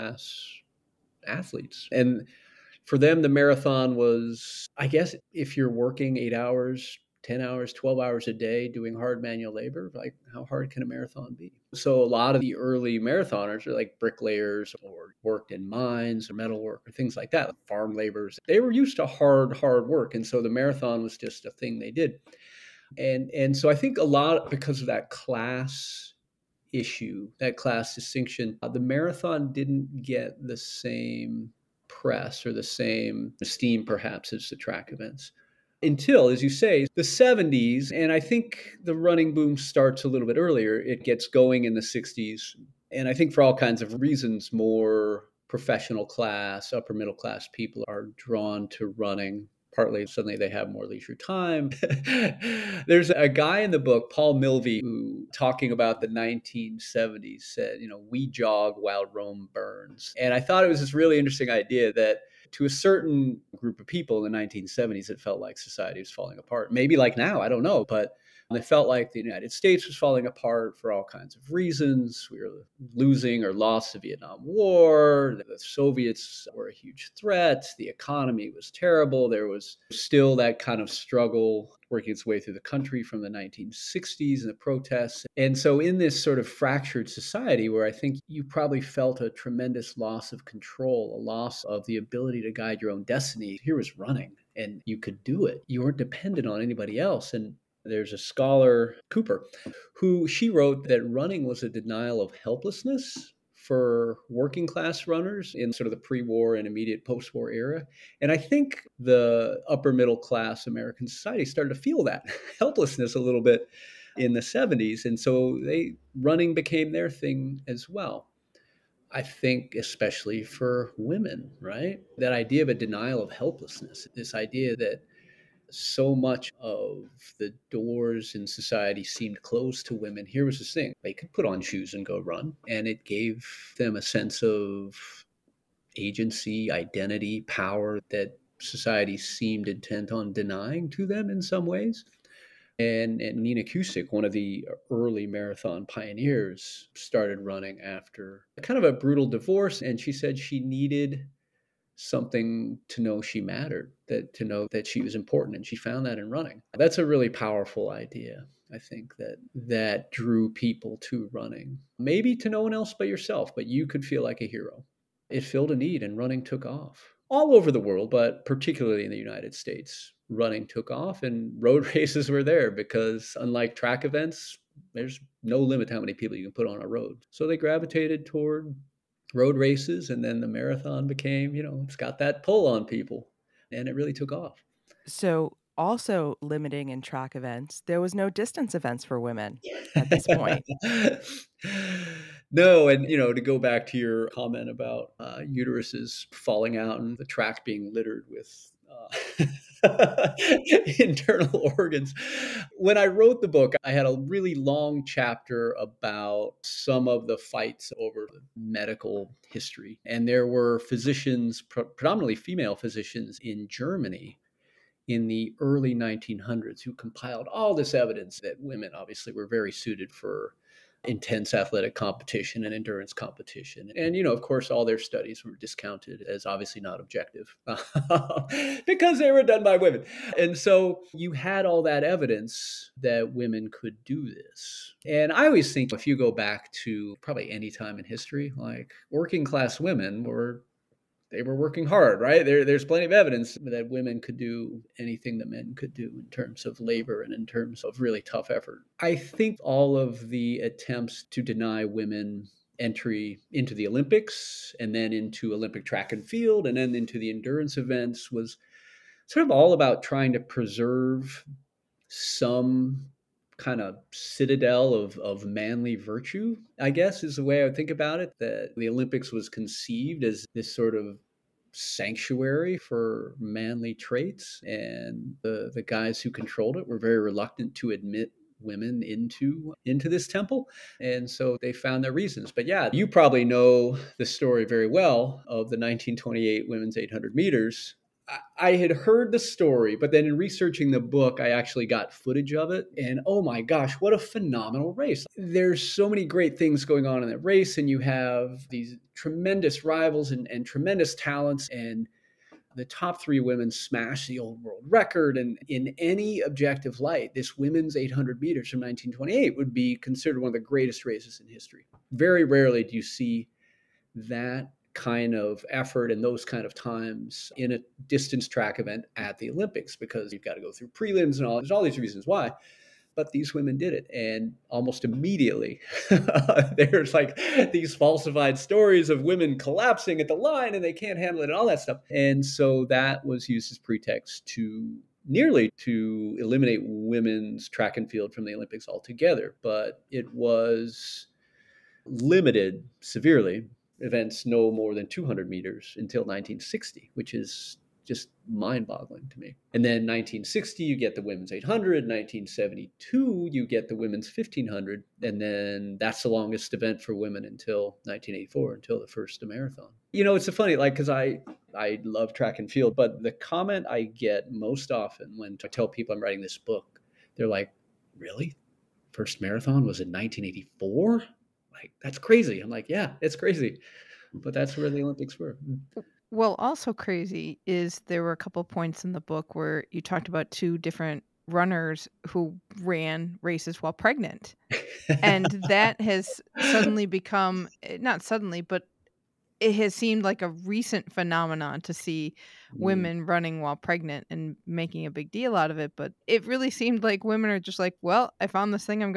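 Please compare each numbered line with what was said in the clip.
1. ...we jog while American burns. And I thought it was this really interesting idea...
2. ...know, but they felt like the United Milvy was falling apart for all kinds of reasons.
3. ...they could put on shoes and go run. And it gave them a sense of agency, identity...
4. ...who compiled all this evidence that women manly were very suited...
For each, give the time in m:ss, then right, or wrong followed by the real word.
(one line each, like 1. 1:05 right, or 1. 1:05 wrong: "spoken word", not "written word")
1. 0:58 wrong: "Rome", not "American"
2. 1:07 wrong: "States", not "Milvy"
3. 2:11 right
4. 3:36 wrong: "obviously", not "manly".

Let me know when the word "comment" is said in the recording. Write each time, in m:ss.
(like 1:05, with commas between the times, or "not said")
3:14, 6:03.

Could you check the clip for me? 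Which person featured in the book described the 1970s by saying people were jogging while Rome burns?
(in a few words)
Paul Milvy.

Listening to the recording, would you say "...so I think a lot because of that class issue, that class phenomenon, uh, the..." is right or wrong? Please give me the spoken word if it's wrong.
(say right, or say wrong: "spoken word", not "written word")
wrong: "distinction", not "phenomenon".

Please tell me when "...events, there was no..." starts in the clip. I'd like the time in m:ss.
3:07.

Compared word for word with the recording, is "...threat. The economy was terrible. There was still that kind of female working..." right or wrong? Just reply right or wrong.
wrong.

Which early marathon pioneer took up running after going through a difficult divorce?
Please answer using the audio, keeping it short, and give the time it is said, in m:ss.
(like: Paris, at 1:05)
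Nina Kuscsik, at 2:23.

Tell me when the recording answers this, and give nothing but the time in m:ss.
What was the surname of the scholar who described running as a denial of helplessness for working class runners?
1:39.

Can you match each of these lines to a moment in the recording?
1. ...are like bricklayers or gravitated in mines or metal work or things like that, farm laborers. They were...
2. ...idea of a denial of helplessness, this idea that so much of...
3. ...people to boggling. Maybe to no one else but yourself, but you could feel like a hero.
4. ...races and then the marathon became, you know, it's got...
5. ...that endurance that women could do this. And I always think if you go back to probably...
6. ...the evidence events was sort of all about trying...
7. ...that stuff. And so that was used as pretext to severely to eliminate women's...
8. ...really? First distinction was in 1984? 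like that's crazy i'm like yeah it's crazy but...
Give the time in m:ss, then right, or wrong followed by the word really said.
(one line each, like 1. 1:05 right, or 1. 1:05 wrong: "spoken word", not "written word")
1. 0:13 wrong: "worked", not "gravitated"
2. 2:02 right
3. 2:40 wrong: "running", not "boggling"
4. 2:59 right
5. 3:51 wrong: "evidence", not "endurance"
6. 4:17 wrong: "endurance", not "evidence"
7. 5:31 wrong: "nearly", not "severely"
8. 6:08 wrong: "marathon", not "distinction".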